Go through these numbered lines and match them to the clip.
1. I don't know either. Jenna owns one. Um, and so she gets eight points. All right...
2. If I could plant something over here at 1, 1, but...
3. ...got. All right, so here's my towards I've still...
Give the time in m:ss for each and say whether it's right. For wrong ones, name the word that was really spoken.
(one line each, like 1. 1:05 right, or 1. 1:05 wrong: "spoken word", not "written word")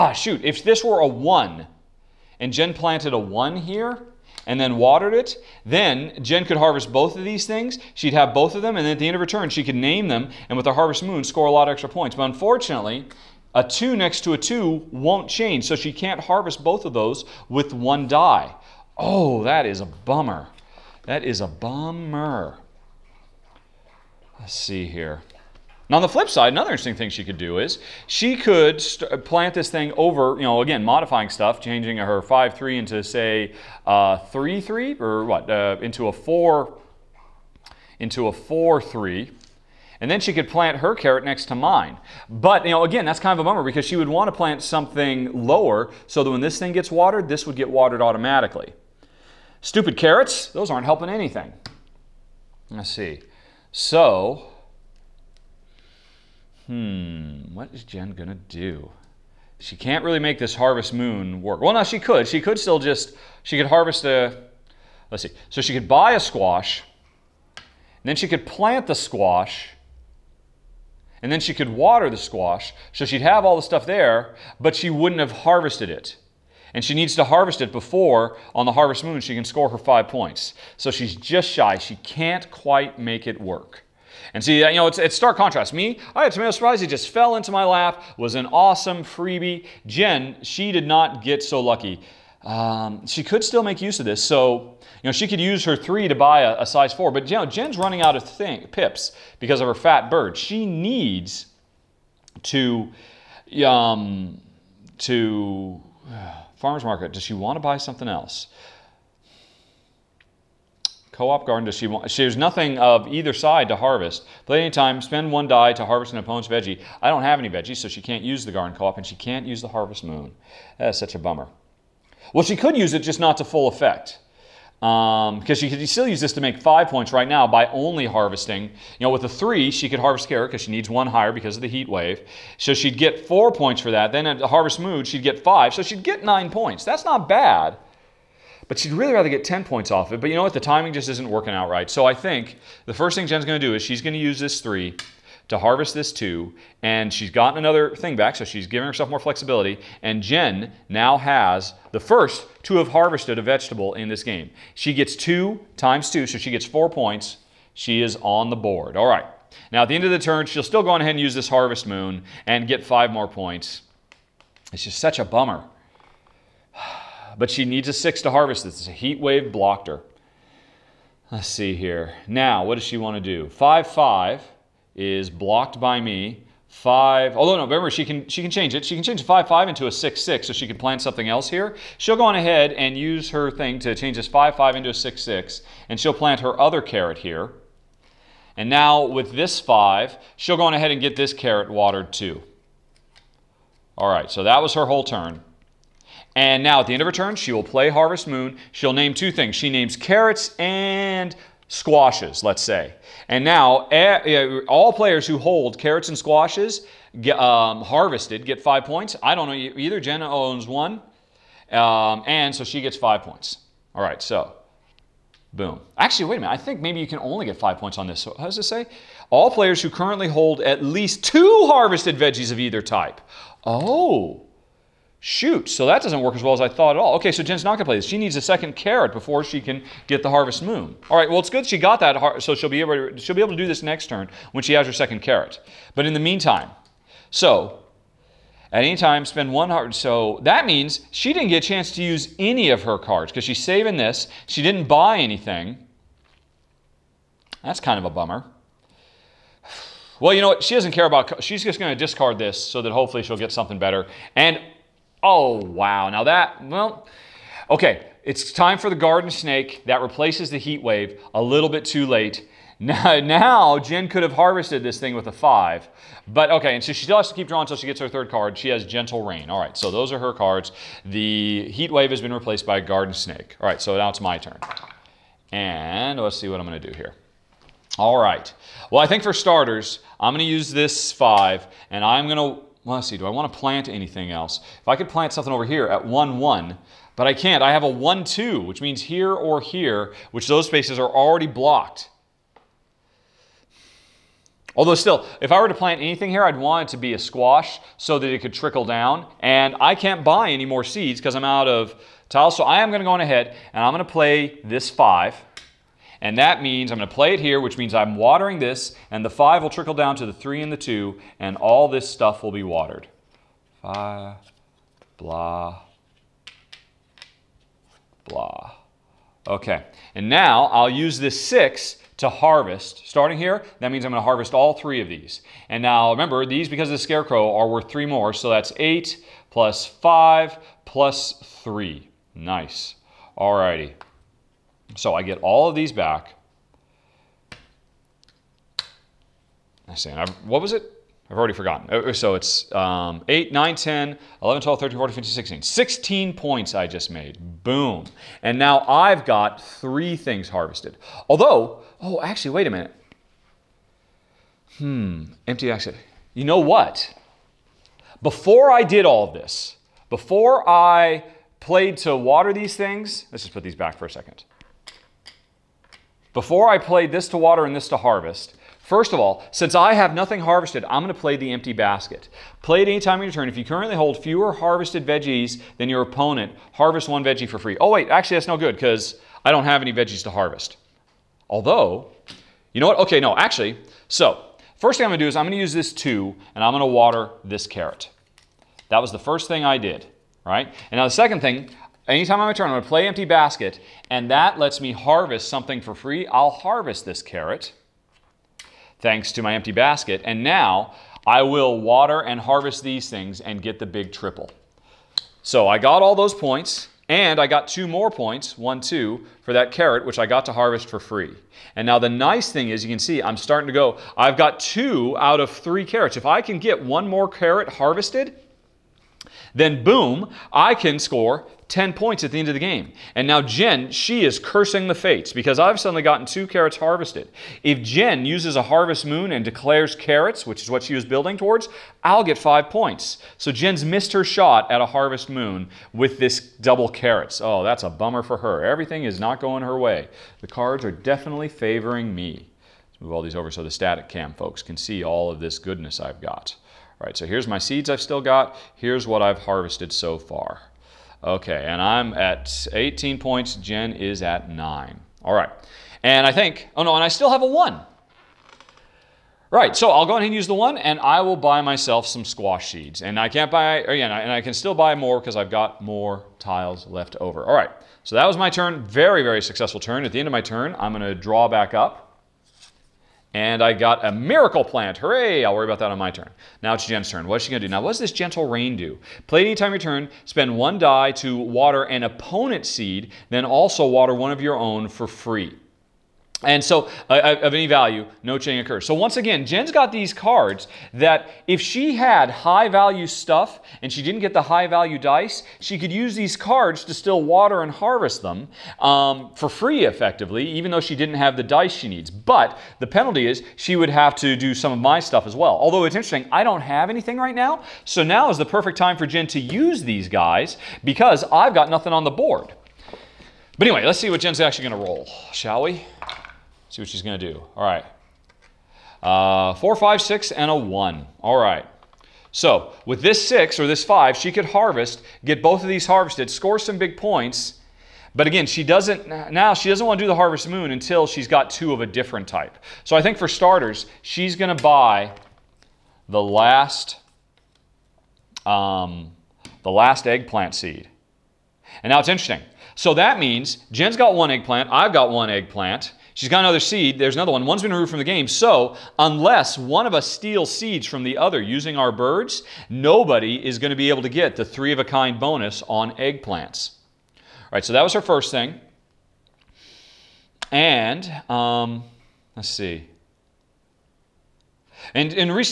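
1. 3:29 wrong: "five", not "eight"
2. 4:44 right
3. 7:26 wrong: "seeds", not "towards".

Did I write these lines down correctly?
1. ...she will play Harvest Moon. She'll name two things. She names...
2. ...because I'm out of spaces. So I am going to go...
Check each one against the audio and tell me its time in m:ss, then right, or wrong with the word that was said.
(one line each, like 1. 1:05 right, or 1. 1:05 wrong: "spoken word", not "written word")
1. 3:17 right
2. 5:01 wrong: "tiles", not "spaces".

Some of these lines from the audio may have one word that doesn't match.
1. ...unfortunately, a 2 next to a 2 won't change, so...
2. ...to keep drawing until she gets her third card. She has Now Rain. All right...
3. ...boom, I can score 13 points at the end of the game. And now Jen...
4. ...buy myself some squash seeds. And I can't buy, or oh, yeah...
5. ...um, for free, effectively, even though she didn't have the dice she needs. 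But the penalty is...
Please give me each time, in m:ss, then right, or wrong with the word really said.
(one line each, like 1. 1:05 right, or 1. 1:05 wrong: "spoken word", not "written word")
1. 0:12 right
2. 4:27 wrong: "Gentle", not "Now"
3. 6:59 wrong: "10", not "13"
4. 7:41 right
5. 8:18 right.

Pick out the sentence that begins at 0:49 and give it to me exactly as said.
Stupid carrots, those aren't helping anything.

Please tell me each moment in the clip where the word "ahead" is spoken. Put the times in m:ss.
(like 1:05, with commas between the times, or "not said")
2:40, 3:02, 3:10, 5:03, 7:40.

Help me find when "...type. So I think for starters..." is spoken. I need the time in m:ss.
8:52.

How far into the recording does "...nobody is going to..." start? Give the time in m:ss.
9:12.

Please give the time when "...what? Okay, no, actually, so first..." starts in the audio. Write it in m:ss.
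6:22.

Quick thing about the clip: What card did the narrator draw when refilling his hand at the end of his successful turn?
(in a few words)
Miracle plant.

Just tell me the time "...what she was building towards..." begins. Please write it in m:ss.
7:10.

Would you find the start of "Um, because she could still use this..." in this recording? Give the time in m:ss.
2:04.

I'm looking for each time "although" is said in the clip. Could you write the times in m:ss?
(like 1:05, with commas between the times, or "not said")
2:57, 4:54, 5:51, 6:21, 8:25.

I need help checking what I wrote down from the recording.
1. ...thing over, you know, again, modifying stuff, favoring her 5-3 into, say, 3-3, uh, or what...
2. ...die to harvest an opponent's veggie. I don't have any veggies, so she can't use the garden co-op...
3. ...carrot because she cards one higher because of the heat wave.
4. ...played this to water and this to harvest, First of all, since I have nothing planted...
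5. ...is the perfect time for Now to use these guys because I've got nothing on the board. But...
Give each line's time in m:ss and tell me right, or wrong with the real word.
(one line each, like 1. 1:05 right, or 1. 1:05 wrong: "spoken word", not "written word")
1. 0:29 wrong: "changing", not "favoring"
2. 1:55 right
3. 2:10 wrong: "needs", not "cards"
4. 6:06 wrong: "harvested", not "planted"
5. 8:28 wrong: "Jen", not "Now".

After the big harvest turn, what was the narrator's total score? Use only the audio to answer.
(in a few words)
18.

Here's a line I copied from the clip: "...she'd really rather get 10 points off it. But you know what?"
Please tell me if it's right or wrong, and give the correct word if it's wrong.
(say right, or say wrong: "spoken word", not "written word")
right.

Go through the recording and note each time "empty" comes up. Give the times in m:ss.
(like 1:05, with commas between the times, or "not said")
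5:55, 6:11, 6:33, 6:39.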